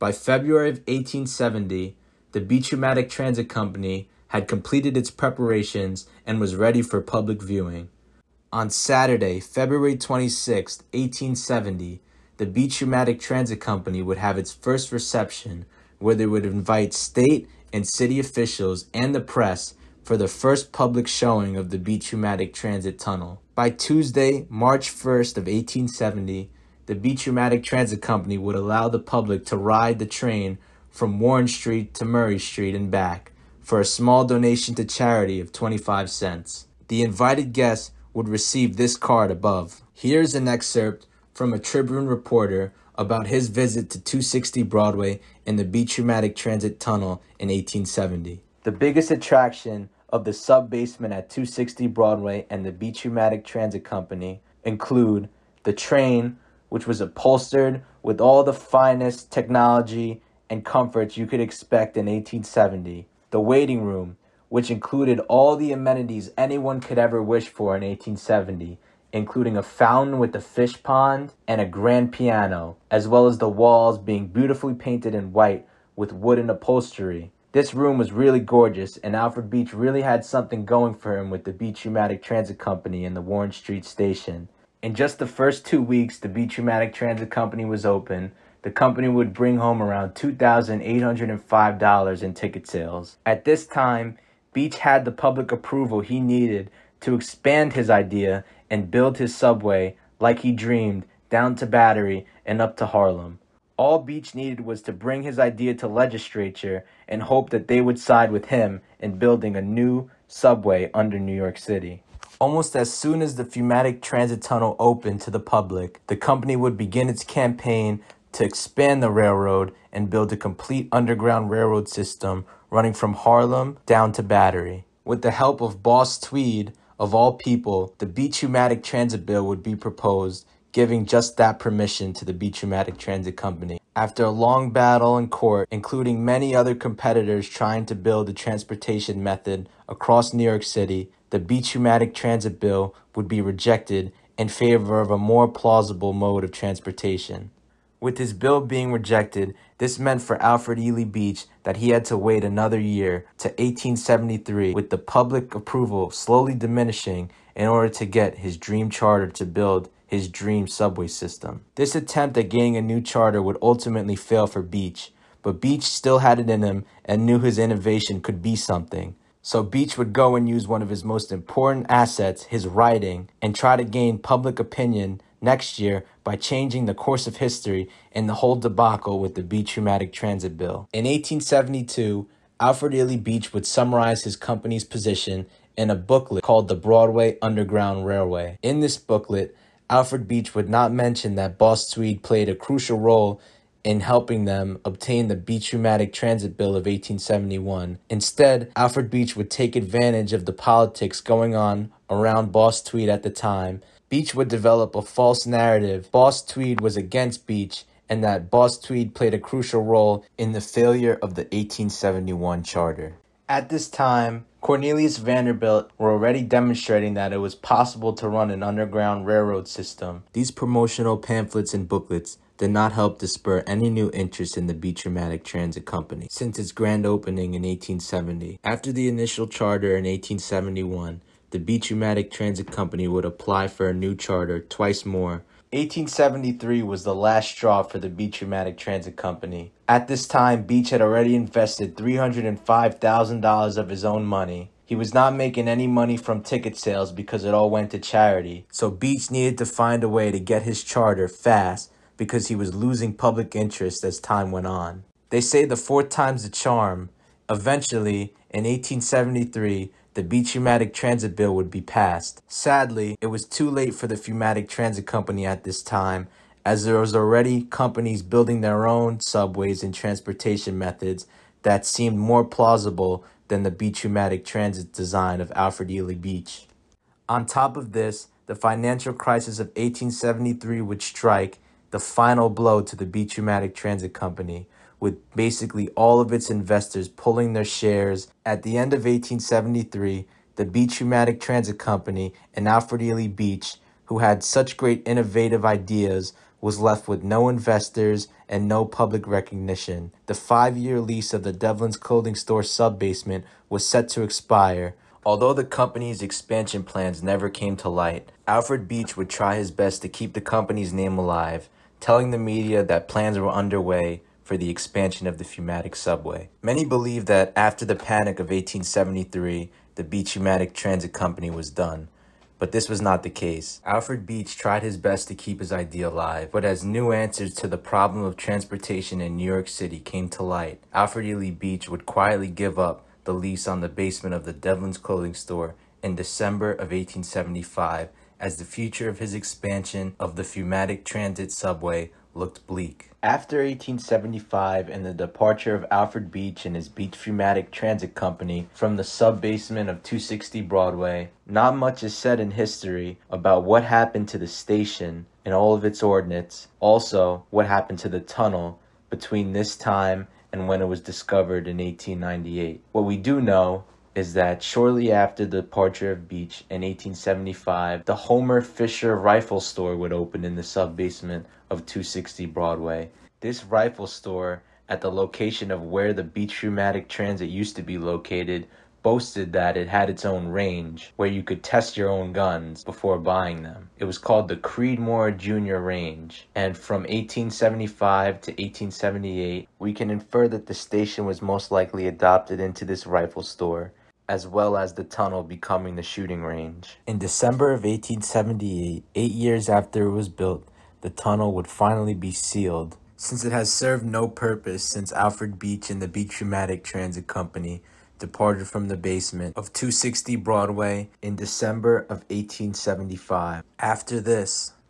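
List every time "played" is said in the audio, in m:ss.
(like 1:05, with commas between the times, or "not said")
3:12, 3:29.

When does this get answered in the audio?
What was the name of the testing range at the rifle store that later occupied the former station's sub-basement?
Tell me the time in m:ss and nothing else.
6:24.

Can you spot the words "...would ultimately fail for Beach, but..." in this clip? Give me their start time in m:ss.
2:43.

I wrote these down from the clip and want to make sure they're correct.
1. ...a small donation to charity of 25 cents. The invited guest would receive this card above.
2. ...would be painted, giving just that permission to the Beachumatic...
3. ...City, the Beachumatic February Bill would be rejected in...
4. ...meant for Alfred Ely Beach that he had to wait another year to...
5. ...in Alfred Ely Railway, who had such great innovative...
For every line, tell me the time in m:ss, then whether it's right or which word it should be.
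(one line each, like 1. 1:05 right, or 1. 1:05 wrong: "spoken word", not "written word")
1. 0:33 right
2. 2:09 wrong: "proposed", not "painted"
3. 2:20 wrong: "Transit", not "February"
4. 2:29 right
5. 4:52 wrong: "Beach", not "Railway".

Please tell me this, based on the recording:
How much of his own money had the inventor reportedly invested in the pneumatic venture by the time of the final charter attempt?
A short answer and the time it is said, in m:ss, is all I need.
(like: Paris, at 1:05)
$305,000, at 4:01.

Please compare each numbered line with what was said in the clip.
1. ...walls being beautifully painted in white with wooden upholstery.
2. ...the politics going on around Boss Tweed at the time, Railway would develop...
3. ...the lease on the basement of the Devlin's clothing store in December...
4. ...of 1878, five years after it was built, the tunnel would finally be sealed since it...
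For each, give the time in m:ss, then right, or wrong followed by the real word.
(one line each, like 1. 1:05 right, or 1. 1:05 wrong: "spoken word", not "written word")
1. 1:13 right
2. 3:20 wrong: "Beach", not "Railway"
3. 5:33 right
4. 6:37 wrong: "eight", not "five".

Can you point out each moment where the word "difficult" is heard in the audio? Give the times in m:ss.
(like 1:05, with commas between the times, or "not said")
not said.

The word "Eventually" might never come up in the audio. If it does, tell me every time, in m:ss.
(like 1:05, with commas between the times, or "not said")
4:17.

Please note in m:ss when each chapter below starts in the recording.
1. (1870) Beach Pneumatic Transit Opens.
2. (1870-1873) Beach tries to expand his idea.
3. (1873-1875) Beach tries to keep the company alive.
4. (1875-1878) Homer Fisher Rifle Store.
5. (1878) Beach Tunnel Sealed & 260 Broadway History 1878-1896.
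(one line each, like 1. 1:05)
1. 0:05
2. 2:02
3. 5:05
4. 5:44
5. 6:35.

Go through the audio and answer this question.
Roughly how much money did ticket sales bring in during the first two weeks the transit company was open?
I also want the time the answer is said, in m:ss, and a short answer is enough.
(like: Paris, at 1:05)
$2,805, at 1:30.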